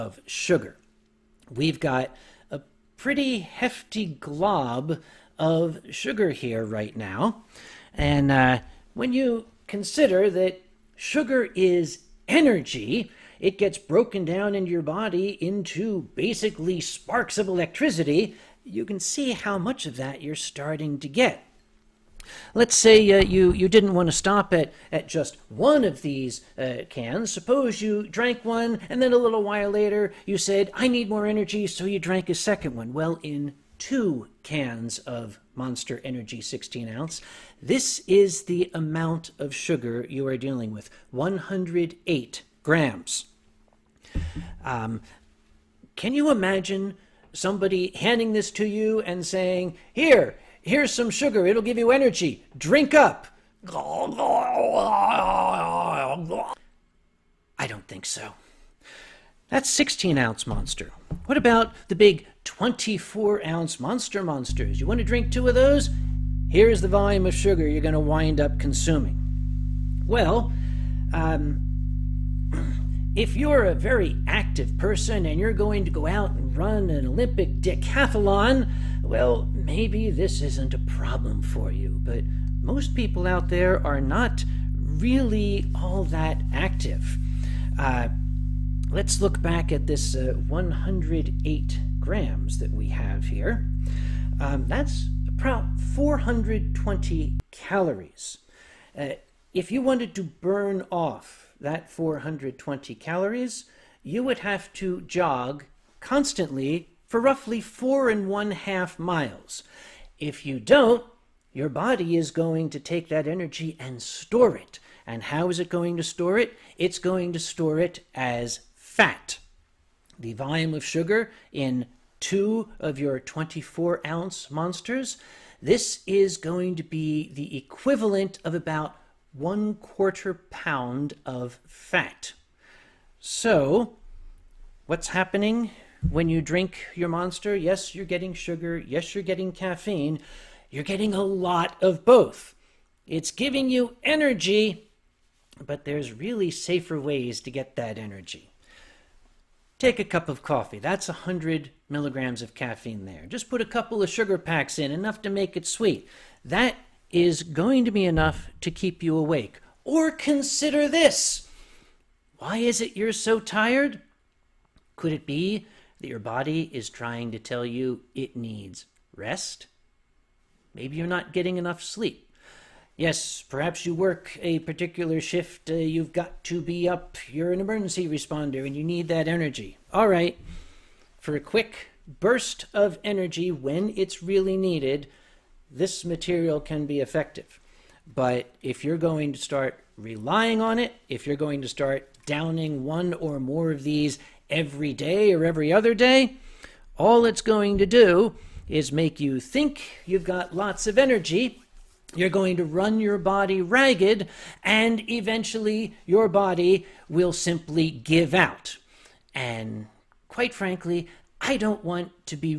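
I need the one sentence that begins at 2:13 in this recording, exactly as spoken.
So what's happening when you drink your monster?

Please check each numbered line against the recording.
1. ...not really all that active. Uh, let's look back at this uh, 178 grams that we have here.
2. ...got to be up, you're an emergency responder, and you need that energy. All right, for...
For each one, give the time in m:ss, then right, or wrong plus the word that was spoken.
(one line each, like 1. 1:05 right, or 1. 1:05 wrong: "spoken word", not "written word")
1. 1:24 wrong: "108", not "178"
2. 2:56 right.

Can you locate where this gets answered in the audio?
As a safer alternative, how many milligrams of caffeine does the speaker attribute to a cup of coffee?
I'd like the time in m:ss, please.
2:31.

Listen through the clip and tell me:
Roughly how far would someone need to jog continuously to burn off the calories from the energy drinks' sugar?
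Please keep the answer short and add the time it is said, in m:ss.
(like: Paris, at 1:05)
4.5 miles, at 1:47.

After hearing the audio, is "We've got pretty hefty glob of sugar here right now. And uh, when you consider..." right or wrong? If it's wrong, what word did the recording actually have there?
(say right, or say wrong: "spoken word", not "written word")
right.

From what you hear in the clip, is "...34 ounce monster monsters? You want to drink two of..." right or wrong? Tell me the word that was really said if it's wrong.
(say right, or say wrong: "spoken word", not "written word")
wrong: "24", not "34".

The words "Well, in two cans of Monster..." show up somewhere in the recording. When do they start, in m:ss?
0:32.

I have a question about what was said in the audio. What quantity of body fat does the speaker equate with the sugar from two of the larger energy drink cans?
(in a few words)
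1/4 pound.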